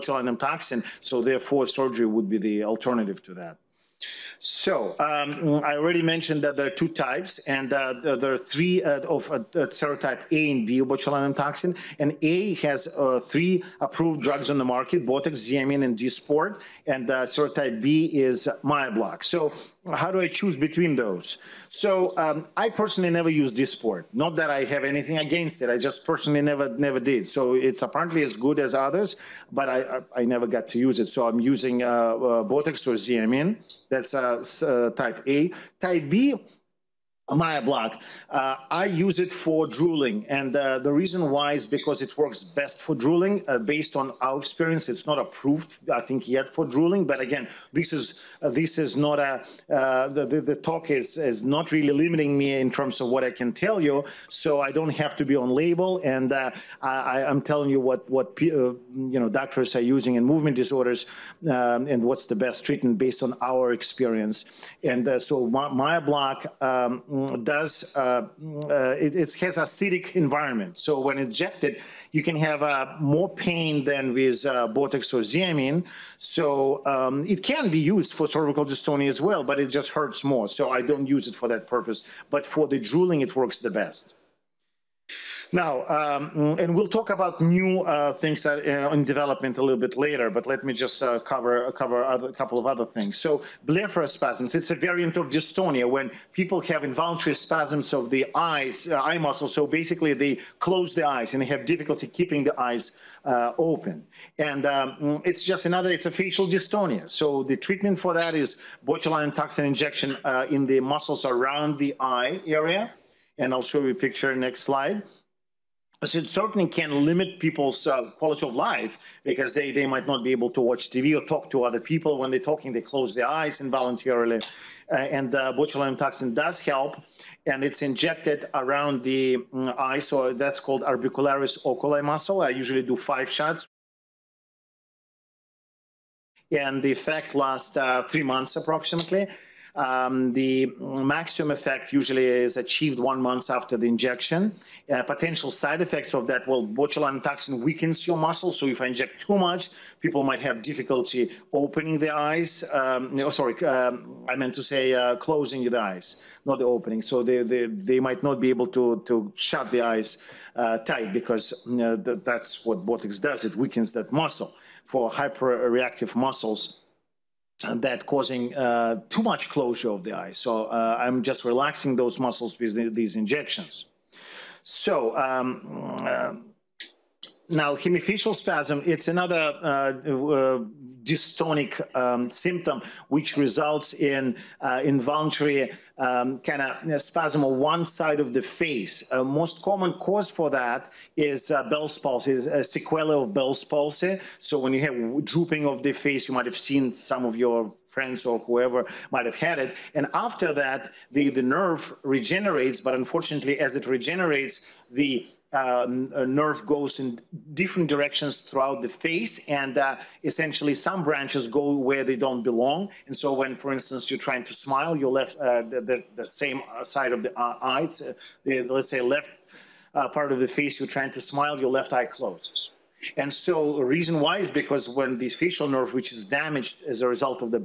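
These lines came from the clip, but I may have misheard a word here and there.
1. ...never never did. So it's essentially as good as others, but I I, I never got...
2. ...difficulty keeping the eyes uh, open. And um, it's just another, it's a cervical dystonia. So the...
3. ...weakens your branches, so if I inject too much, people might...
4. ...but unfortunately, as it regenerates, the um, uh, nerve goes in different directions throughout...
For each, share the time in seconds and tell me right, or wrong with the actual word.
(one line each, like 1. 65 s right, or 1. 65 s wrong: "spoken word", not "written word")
1. 26 s wrong: "apparently", not "essentially"
2. 101 s wrong: "facial", not "cervical"
3. 147 s wrong: "muscles", not "branches"
4. 202 s right.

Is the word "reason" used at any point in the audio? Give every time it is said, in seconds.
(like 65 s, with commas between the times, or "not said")
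40 s, 223 s.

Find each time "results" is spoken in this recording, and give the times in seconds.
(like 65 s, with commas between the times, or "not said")
183 s, 227 s.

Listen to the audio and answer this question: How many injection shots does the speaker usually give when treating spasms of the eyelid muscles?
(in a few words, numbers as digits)
5.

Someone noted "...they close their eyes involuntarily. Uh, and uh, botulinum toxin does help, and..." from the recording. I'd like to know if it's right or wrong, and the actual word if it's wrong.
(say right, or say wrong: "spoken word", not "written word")
right.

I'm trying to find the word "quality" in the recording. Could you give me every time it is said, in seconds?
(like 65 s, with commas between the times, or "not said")
118 s.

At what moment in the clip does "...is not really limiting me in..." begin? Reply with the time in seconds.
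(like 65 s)
51 s.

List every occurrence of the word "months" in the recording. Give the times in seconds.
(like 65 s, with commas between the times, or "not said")
138 s, 143 s.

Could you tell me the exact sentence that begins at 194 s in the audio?
So when you have drooping of the face, you might have seen some of your friends or whoever might have had it.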